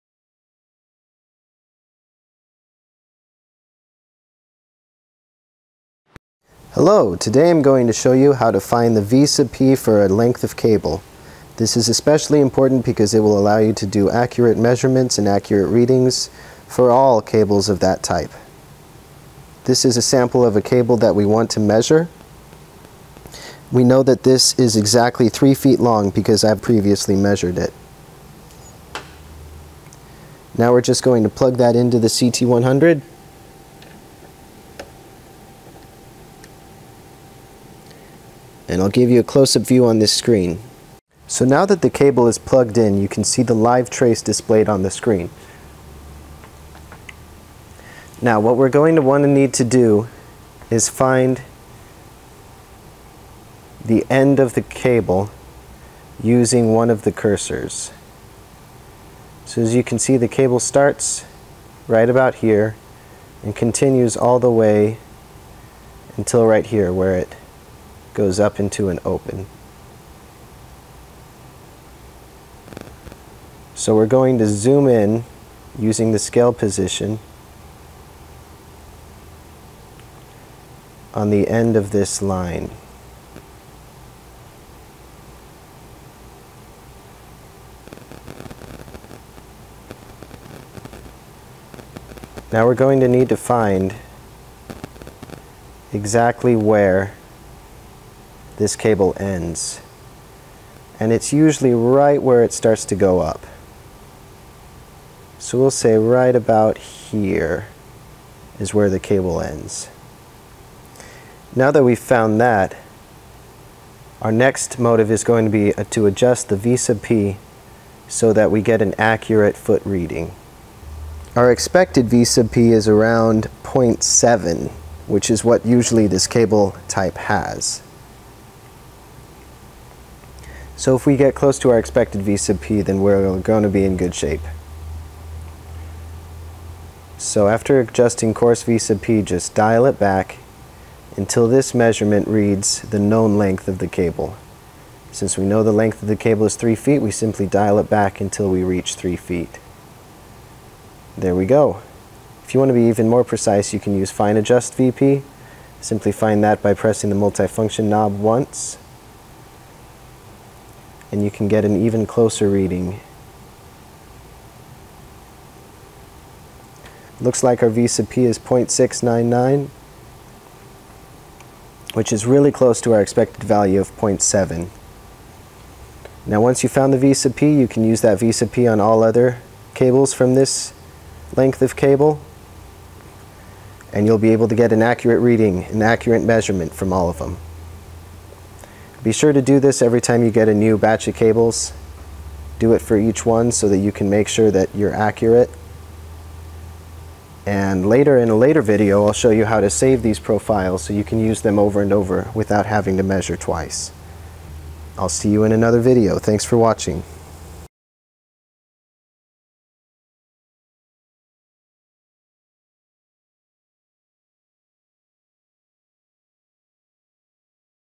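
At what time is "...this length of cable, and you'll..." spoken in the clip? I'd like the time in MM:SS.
03:00.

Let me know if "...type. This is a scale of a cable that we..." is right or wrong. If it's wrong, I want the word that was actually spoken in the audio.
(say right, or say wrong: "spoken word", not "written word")
wrong: "sample", not "scale".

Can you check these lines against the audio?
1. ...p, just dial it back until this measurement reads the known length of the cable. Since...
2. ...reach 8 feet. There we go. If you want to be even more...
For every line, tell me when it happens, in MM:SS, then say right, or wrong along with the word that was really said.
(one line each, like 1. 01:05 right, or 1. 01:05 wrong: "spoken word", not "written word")
1. 02:18 right
2. 02:28 wrong: "3", not "8".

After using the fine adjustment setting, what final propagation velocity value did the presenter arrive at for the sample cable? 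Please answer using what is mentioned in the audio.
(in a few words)
0.699.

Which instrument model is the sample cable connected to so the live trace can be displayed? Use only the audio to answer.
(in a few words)
CT100.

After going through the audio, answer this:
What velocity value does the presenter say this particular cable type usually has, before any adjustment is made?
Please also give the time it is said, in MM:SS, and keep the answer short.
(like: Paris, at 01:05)
0.7, at 02:02.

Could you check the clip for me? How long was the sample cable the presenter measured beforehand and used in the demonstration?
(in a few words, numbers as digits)
3 feet.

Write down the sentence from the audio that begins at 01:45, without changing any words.
So we'll say right about here is where the cable ends.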